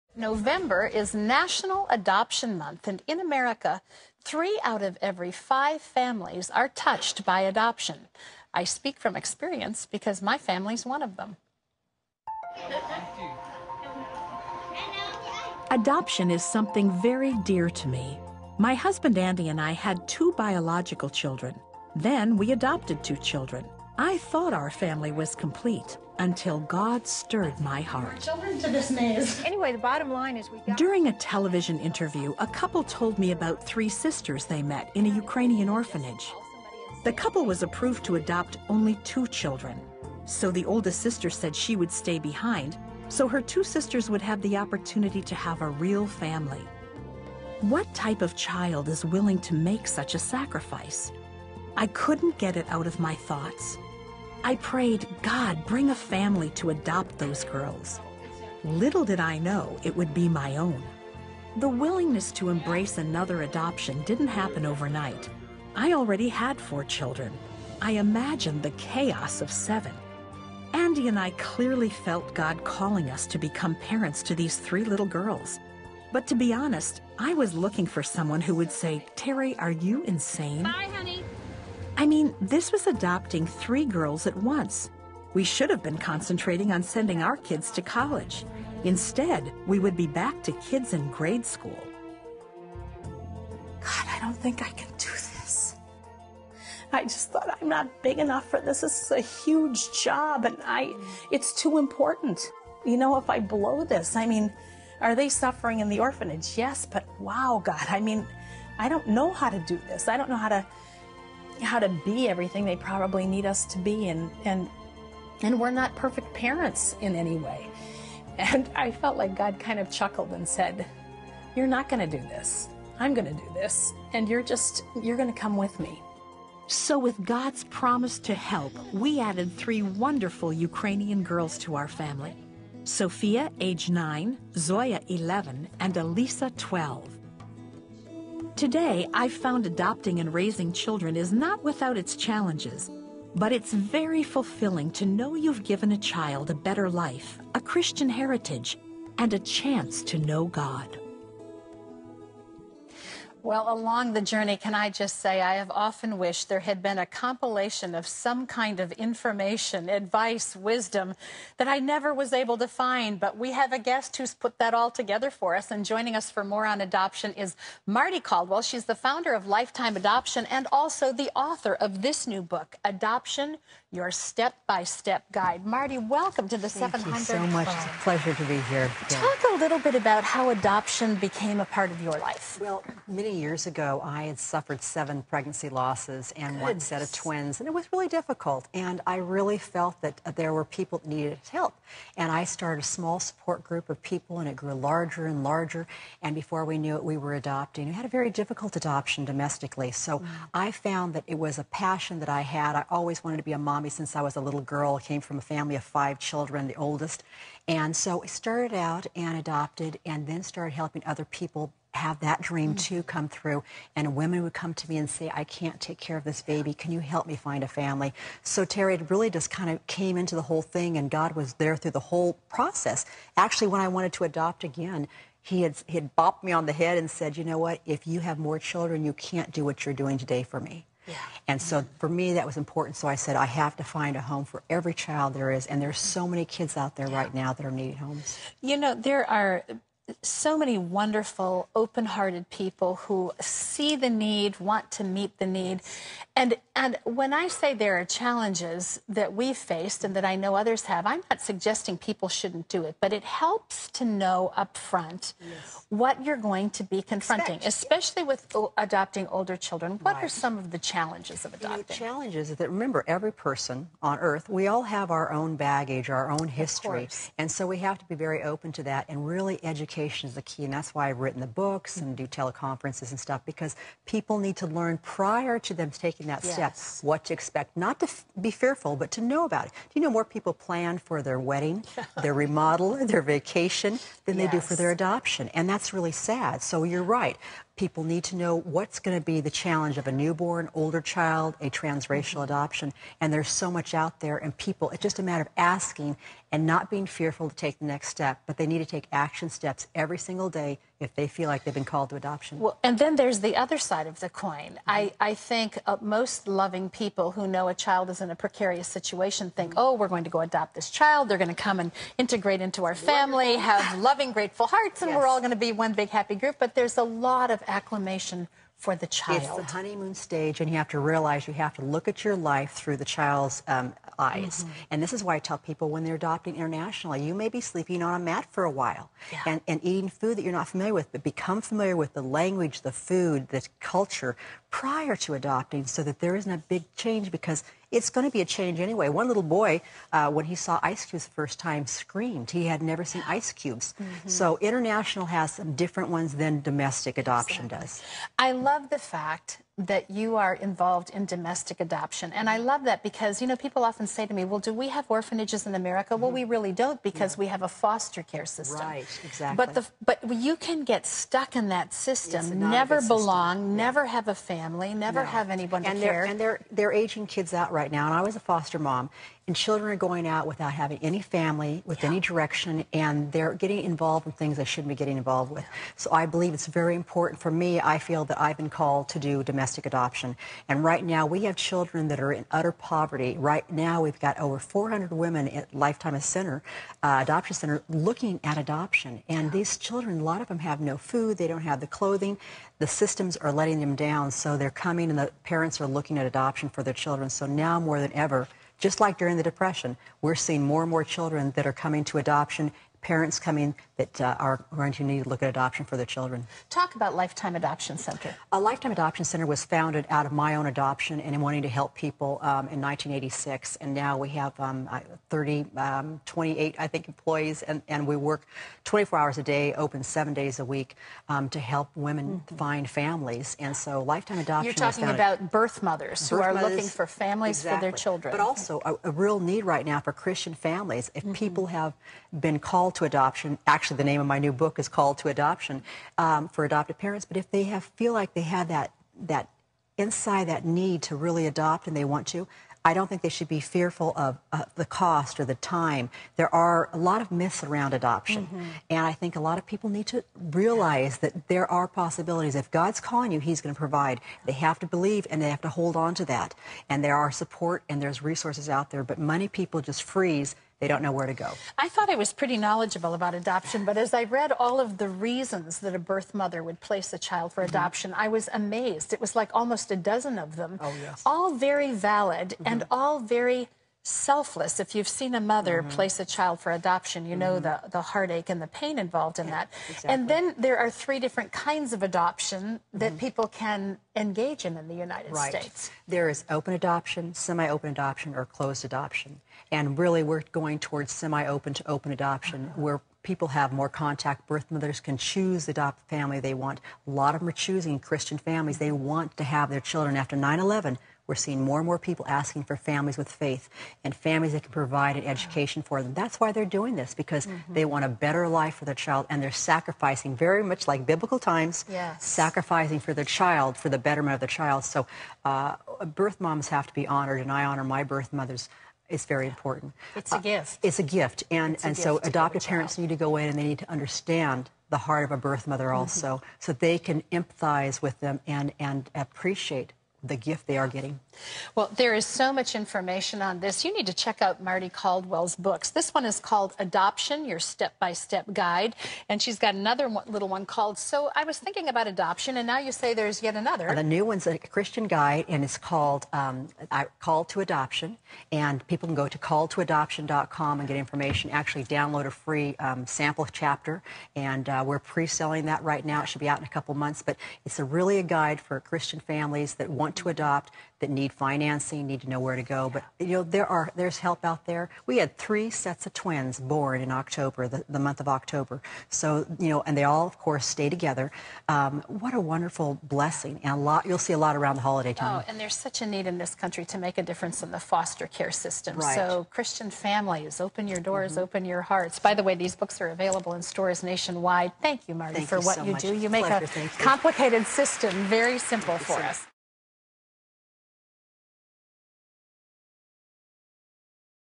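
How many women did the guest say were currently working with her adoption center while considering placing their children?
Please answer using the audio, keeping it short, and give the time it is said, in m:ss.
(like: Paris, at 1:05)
over 400, at 6:24.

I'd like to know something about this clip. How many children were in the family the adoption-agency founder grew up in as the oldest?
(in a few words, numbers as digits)
5.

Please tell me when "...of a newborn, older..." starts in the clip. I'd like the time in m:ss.
4:49.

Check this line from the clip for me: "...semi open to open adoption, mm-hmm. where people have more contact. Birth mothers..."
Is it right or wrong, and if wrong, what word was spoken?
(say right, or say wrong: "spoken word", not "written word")
right.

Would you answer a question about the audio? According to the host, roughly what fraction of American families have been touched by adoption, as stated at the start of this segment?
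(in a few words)
three out of every five.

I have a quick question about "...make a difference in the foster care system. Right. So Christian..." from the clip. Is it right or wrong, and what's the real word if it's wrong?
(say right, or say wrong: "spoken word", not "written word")
right.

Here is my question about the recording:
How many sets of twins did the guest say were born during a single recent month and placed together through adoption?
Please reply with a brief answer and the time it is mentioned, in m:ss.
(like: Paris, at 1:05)
3, at 9:25.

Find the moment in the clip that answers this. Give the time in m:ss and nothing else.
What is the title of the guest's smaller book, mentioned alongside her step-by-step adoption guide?
9:00.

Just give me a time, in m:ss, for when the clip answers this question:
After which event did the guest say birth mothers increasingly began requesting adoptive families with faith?
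8:20.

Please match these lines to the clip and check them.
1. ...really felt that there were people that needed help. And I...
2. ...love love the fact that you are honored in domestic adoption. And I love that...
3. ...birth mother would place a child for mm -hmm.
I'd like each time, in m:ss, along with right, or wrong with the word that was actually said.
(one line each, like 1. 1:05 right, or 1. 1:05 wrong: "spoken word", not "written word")
1. 3:09 right
2. 5:48 wrong: "involved", not "honored"
3. 7:45 right.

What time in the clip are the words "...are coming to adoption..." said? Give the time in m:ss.
6:41.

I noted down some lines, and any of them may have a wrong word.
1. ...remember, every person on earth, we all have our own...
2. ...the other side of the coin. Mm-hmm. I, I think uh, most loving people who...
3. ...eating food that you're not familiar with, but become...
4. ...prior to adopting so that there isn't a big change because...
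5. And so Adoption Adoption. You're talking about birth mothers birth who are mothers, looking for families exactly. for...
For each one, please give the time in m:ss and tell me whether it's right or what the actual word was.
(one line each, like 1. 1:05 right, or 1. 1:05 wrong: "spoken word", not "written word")
1. 4:22 right
2. 5:03 right
3. 5:29 right
4. 5:34 right
5. 7:03 wrong: "Lifetime", not "Adoption".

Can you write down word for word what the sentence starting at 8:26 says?
That's why they're doing this, because mm-hmm.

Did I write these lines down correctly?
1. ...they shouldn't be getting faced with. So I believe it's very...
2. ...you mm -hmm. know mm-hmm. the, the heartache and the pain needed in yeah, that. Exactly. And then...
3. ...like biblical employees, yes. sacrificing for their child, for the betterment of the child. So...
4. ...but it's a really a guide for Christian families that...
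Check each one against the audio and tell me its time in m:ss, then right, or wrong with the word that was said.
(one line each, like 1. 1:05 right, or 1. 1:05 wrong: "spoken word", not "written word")
1. 6:14 wrong: "involved", not "faced"
2. 7:57 wrong: "involved", not "needed"
3. 8:30 wrong: "times", not "employees"
4. 9:17 right.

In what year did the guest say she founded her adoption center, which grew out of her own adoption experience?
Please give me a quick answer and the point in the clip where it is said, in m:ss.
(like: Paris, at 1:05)
1986, at 6:52.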